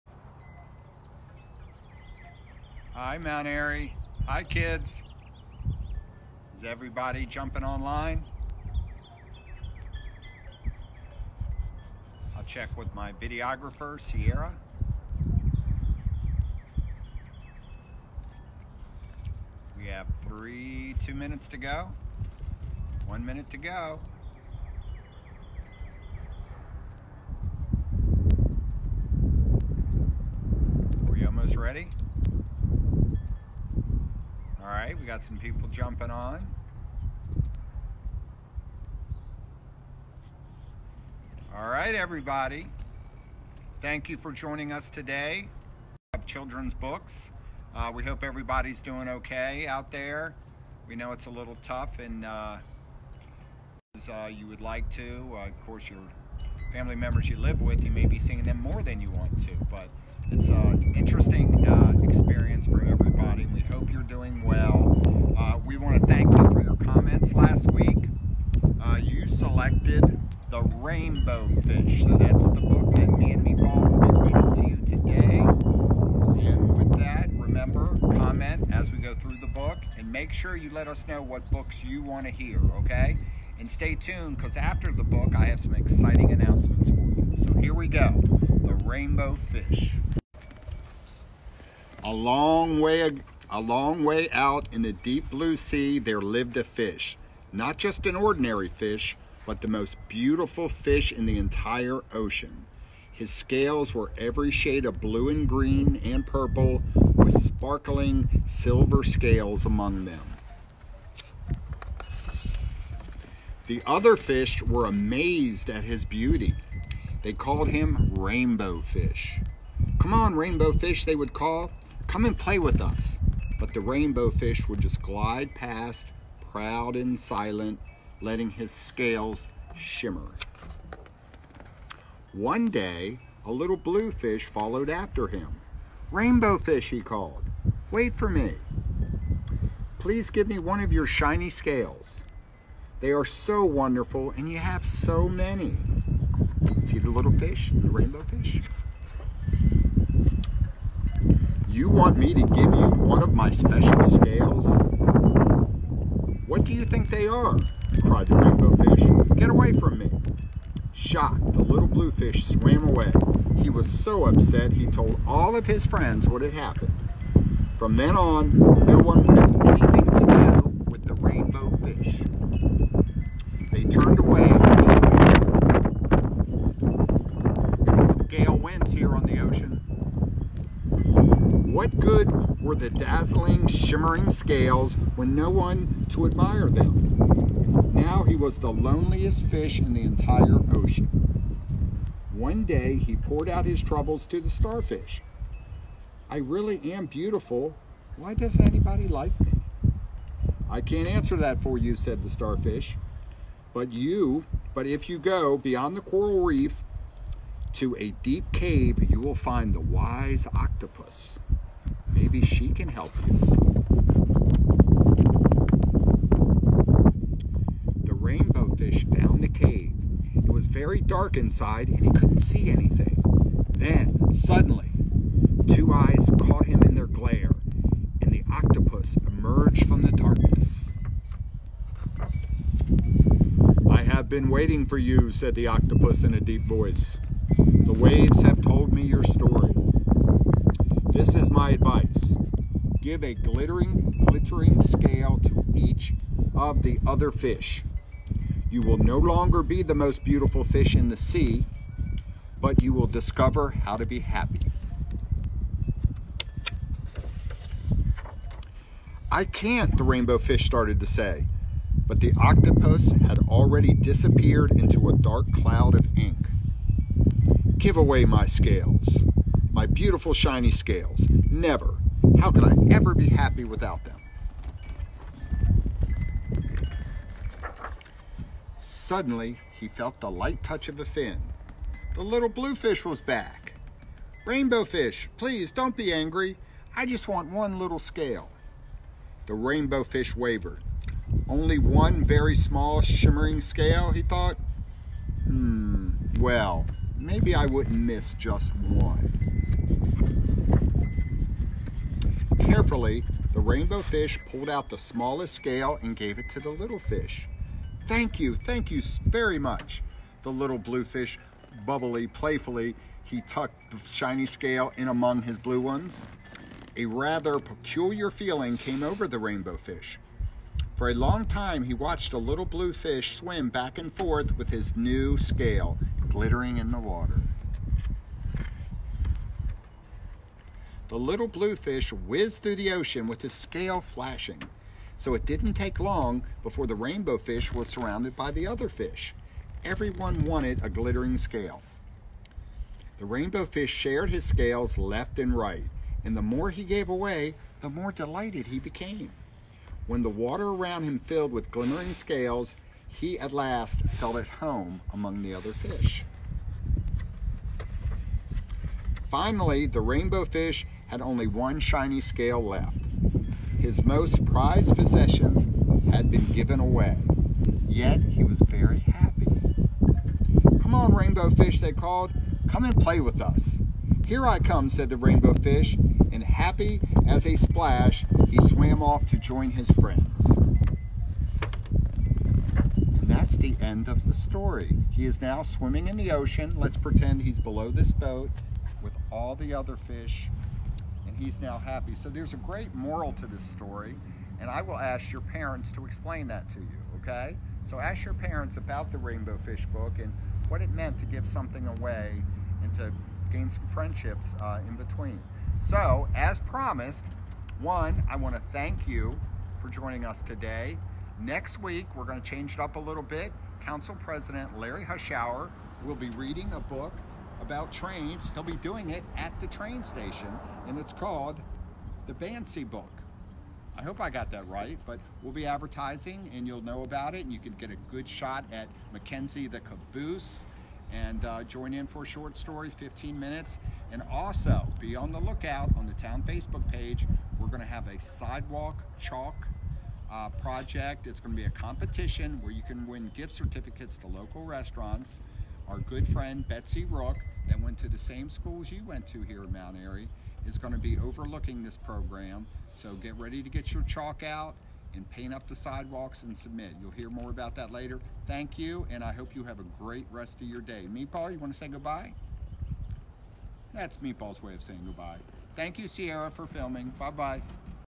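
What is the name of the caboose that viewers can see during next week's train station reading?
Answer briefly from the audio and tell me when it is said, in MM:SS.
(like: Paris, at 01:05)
Mackenzie, at 07:09.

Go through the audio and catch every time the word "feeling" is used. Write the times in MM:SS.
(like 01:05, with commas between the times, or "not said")
05:18.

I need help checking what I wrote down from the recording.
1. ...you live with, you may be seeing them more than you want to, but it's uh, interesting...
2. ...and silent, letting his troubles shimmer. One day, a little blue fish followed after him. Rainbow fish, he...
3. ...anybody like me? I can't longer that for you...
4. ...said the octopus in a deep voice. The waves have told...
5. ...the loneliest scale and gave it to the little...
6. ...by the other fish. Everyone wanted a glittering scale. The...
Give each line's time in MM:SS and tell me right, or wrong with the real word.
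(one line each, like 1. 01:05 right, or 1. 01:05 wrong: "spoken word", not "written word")
1. 00:57 right
2. 02:06 wrong: "scales", not "troubles"
3. 03:18 wrong: "answer", not "longer"
4. 03:55 right
5. 05:04 wrong: "smallest", not "loneliest"
6. 05:38 right.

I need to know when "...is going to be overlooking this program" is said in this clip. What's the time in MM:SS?
07:30.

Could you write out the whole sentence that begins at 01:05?
Uh, we want to thank you for your comments last week.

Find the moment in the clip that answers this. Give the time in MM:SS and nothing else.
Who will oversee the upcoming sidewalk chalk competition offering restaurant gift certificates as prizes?
07:26.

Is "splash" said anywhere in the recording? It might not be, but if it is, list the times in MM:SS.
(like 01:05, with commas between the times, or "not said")
06:17.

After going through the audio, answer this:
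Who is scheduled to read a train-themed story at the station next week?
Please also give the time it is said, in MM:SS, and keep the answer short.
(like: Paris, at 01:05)
Larry Hushour, at 06:54.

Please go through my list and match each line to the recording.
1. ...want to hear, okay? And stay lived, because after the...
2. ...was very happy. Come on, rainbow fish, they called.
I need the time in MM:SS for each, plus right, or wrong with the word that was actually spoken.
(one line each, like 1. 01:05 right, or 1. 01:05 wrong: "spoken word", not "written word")
1. 01:22 wrong: "tuned", not "lived"
2. 06:08 right.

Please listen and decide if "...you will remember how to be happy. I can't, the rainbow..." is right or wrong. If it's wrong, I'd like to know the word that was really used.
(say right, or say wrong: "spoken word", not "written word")
wrong: "discover", not "remember".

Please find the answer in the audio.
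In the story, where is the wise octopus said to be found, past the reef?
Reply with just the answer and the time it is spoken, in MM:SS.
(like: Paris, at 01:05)
a deep cave, at 03:27.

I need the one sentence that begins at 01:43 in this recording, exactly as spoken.
His scales were every shade of blue and green and purple, with sparkling silver scales among them.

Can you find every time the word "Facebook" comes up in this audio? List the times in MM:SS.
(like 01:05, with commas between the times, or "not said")
07:16.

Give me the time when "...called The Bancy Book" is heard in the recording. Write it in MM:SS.
07:01.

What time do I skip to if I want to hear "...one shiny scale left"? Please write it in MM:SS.
06:01.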